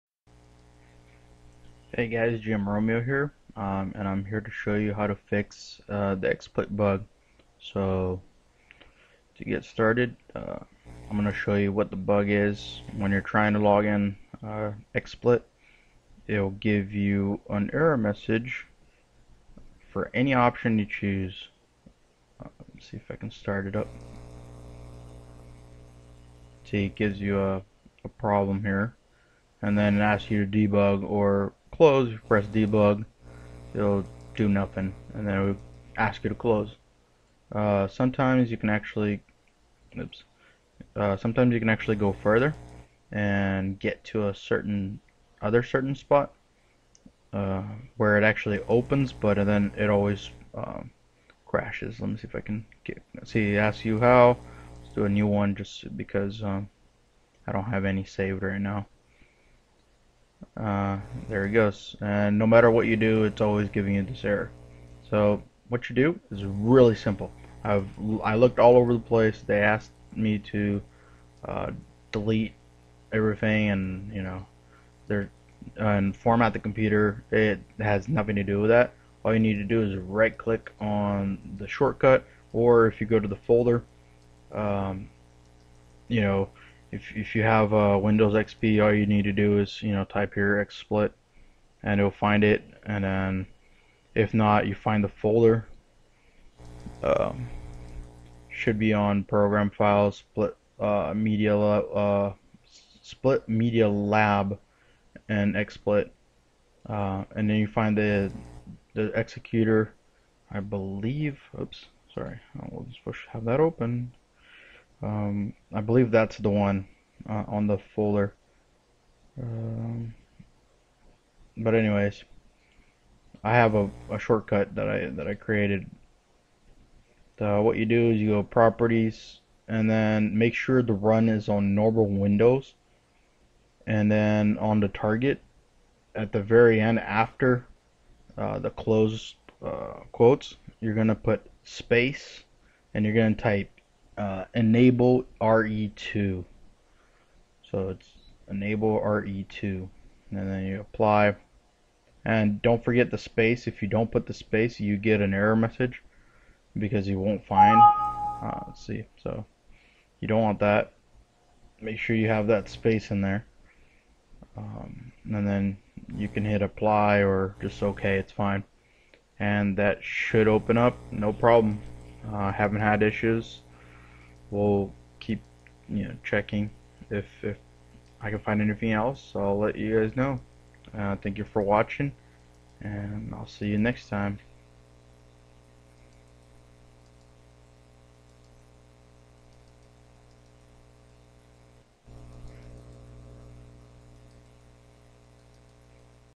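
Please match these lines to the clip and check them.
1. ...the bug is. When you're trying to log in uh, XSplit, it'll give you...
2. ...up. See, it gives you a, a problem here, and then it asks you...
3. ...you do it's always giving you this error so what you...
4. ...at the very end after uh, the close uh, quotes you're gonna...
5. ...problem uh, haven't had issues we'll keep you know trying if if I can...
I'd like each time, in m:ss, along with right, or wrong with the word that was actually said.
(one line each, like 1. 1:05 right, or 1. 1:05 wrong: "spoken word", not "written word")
1. 0:11 right
2. 0:23 right
3. 1:02 right
4. 2:16 right
5. 2:51 wrong: "checking", not "trying".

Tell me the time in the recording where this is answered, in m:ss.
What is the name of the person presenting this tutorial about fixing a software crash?
0:02.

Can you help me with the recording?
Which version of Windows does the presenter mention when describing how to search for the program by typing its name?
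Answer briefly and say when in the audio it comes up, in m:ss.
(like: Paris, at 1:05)
Windows XP, at 1:28.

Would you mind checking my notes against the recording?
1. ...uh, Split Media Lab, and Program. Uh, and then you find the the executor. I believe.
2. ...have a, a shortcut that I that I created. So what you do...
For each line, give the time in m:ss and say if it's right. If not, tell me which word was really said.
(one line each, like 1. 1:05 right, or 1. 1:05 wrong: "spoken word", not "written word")
1. 1:41 wrong: "XSplit", not "Program"
2. 2:03 right.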